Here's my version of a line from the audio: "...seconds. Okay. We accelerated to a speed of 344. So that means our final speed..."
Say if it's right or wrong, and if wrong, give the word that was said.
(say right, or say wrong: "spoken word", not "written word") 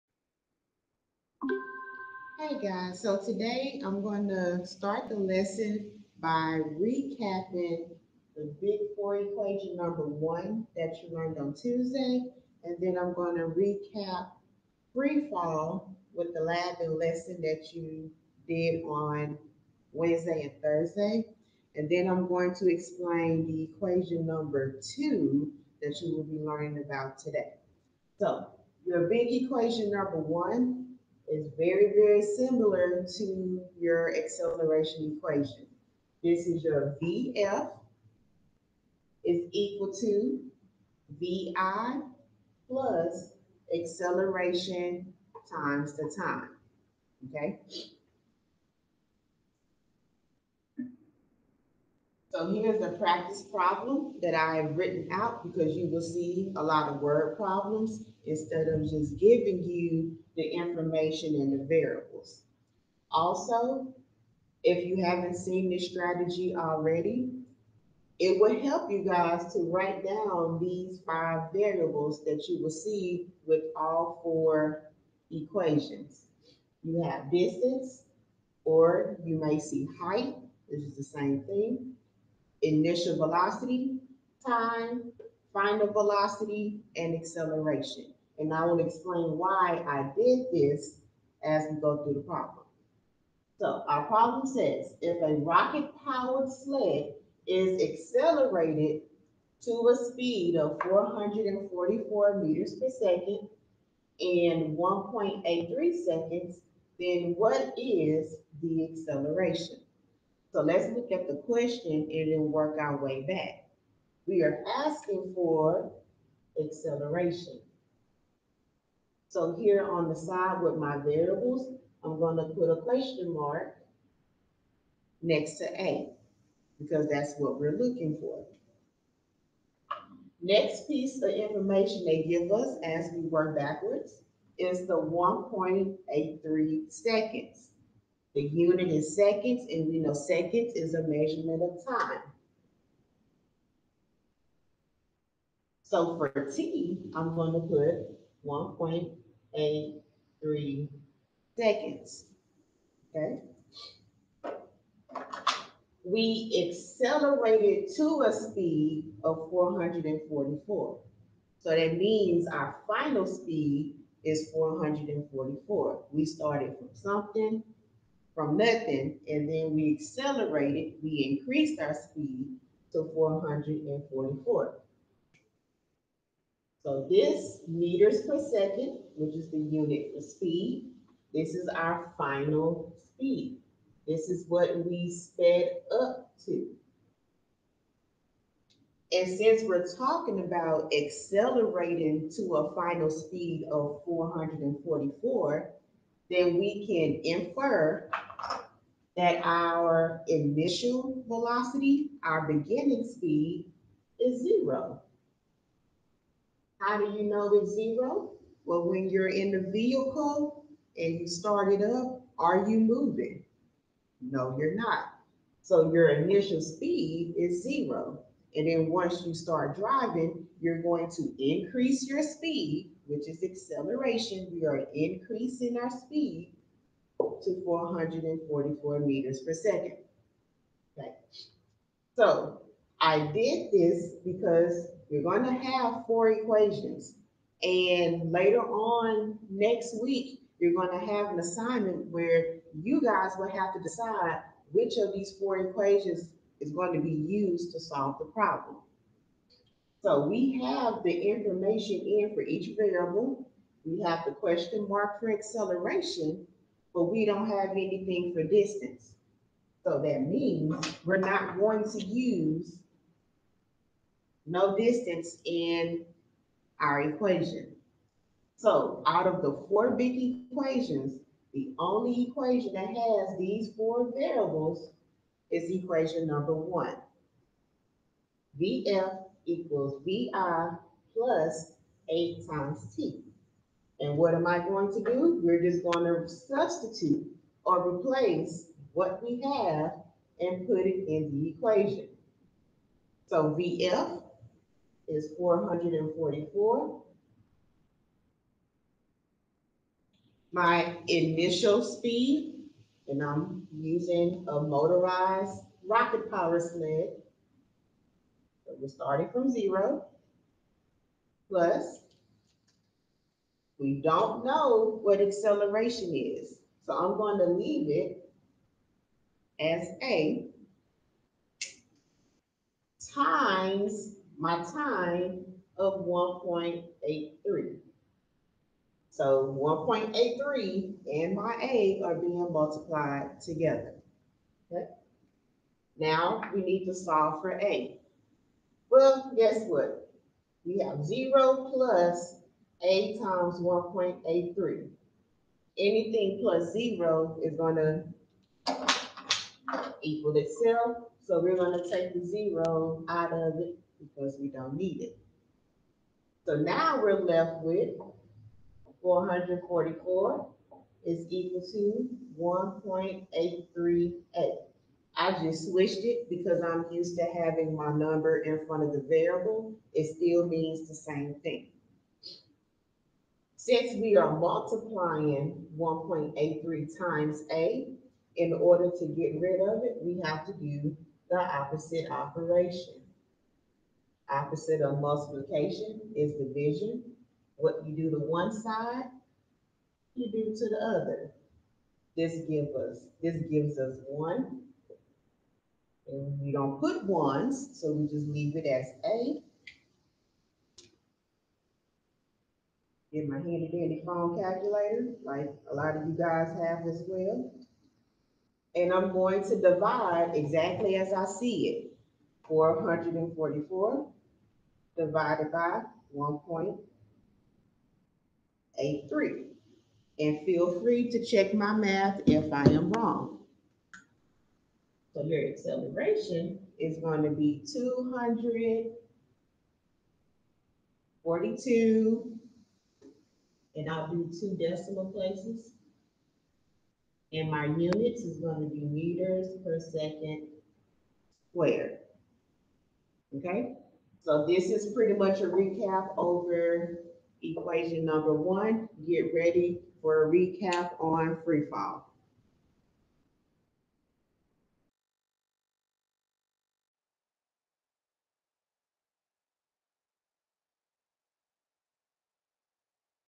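wrong: "444", not "344".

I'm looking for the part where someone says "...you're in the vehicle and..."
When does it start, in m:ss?
3:29.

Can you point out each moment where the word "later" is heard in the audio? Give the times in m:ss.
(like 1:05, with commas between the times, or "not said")
3:58.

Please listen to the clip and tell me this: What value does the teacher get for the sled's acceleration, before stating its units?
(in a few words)
242.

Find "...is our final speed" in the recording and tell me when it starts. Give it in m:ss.
3:01.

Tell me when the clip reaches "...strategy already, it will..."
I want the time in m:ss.
1:05.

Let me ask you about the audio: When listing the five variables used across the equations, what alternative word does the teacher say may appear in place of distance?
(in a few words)
height.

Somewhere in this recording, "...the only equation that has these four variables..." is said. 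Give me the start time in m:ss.
4:31.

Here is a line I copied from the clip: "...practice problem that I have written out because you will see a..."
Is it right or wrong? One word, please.
right.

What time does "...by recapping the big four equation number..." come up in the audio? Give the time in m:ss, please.
0:06.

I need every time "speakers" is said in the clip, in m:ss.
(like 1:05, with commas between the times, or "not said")
not said.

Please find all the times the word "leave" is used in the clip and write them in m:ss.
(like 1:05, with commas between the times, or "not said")
5:17, 6:38.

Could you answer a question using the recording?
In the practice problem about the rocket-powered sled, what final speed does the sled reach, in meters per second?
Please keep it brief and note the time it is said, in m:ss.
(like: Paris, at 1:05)
444, at 1:40.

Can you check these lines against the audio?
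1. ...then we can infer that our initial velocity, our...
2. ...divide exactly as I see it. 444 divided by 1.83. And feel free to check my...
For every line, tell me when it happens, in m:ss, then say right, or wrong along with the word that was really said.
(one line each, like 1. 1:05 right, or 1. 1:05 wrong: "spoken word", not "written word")
1. 3:16 right
2. 6:49 right.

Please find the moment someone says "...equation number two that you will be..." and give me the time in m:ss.
0:23.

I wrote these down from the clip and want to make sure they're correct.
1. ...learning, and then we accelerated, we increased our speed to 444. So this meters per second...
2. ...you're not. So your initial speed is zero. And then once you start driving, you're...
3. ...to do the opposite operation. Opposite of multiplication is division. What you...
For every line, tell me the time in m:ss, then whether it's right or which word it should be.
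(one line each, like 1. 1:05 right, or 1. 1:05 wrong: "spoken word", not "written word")
1. 2:48 wrong: "nothing", not "learning"
2. 3:34 right
3. 6:20 right.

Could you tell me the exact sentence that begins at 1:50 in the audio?
So let's look at the question and then work our way back.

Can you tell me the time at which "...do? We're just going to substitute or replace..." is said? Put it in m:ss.
4:44.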